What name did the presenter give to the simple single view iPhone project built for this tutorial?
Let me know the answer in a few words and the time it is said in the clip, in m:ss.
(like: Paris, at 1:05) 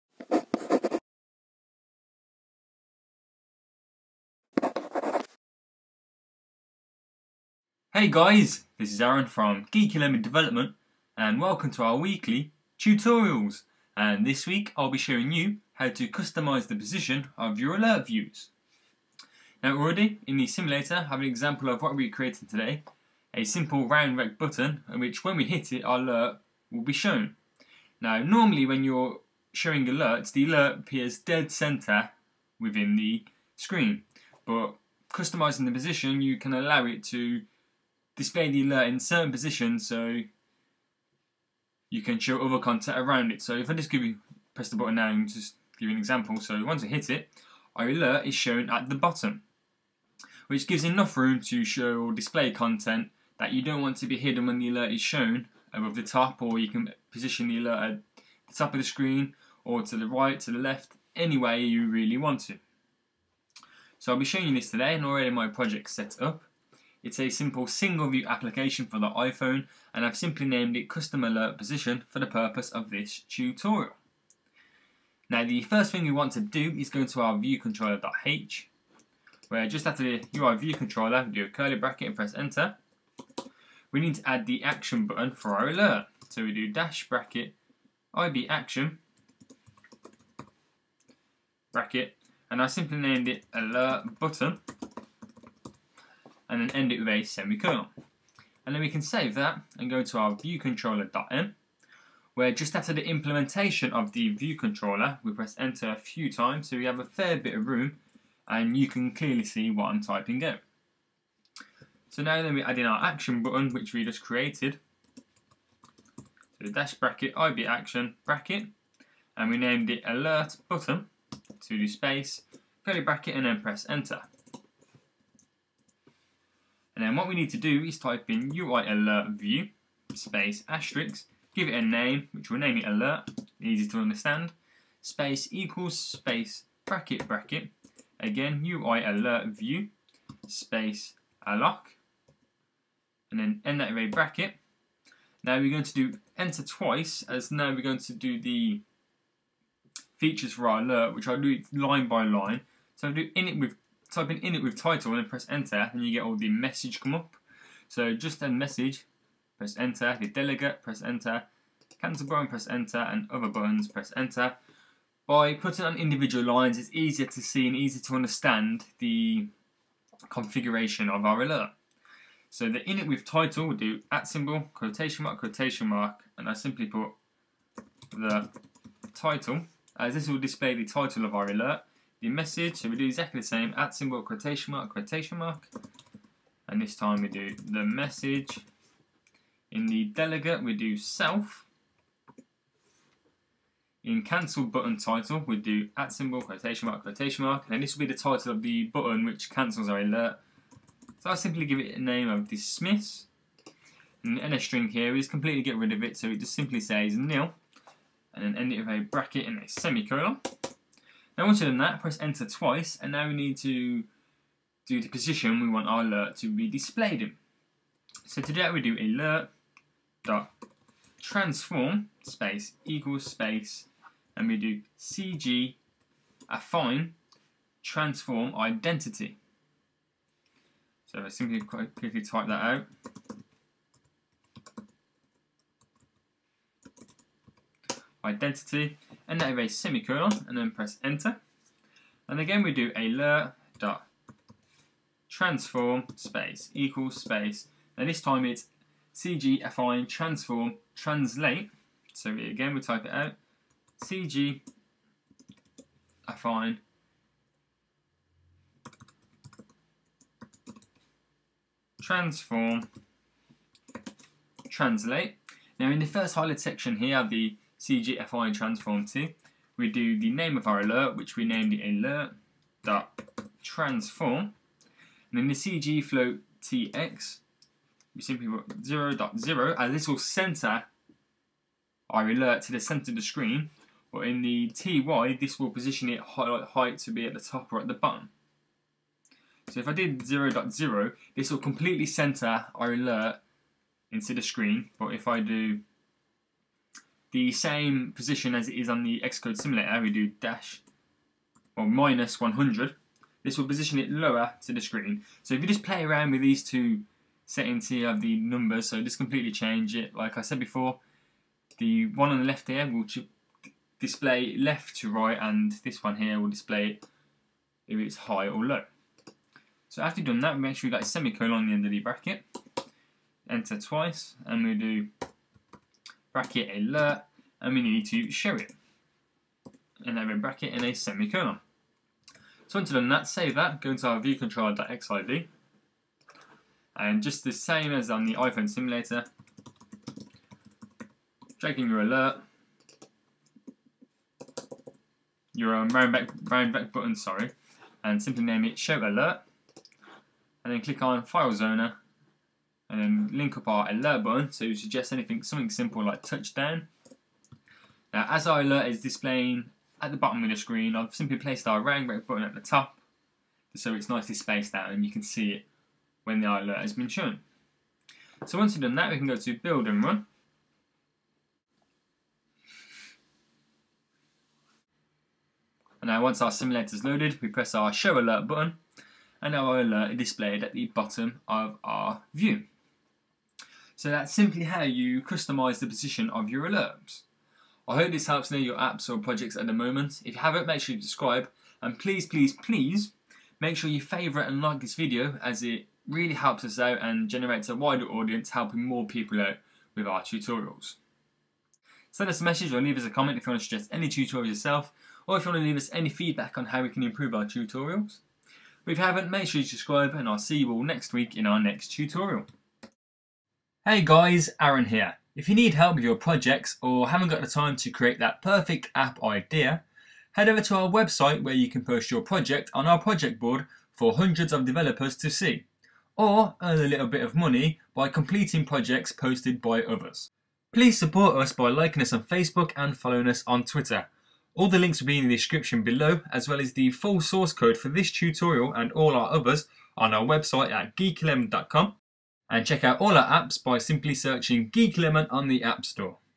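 Custom Alert Position, at 1:10.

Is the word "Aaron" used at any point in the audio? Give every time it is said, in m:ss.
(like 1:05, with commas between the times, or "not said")
0:09, 6:54.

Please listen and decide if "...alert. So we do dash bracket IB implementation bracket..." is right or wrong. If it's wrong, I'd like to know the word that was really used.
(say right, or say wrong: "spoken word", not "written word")
wrong: "action", not "implementation".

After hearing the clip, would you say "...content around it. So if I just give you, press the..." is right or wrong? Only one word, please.
right.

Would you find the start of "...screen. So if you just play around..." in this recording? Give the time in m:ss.
5:04.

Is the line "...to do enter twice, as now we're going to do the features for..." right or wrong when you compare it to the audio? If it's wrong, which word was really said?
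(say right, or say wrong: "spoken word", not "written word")
right.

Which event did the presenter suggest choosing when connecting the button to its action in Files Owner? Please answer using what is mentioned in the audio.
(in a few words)
touchdown.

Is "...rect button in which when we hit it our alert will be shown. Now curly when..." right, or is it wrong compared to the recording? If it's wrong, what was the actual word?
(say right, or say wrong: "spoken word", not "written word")
wrong: "normally", not "curly".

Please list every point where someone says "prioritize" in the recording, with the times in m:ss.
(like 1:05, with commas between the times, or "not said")
not said.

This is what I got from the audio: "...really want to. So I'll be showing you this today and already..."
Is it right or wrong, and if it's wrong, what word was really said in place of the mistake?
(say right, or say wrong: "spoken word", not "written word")
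right.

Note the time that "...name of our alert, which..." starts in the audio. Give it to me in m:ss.
4:30.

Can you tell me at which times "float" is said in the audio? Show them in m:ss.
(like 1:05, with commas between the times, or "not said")
4:36.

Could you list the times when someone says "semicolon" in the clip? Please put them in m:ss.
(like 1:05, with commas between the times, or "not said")
1:37, 3:29, 3:59, 5:21, 5:30.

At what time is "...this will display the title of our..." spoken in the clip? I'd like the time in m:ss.
3:00.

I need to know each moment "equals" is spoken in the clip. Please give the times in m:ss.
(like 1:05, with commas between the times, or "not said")
2:15, 3:42, 4:06.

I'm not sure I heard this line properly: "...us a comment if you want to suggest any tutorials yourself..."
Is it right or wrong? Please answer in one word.
right.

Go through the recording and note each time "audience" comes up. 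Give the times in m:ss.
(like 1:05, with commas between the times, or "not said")
6:38.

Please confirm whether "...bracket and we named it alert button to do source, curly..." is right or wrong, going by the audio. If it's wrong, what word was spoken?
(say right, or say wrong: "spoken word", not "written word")
wrong: "space", not "source".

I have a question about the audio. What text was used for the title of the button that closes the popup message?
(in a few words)
dismiss.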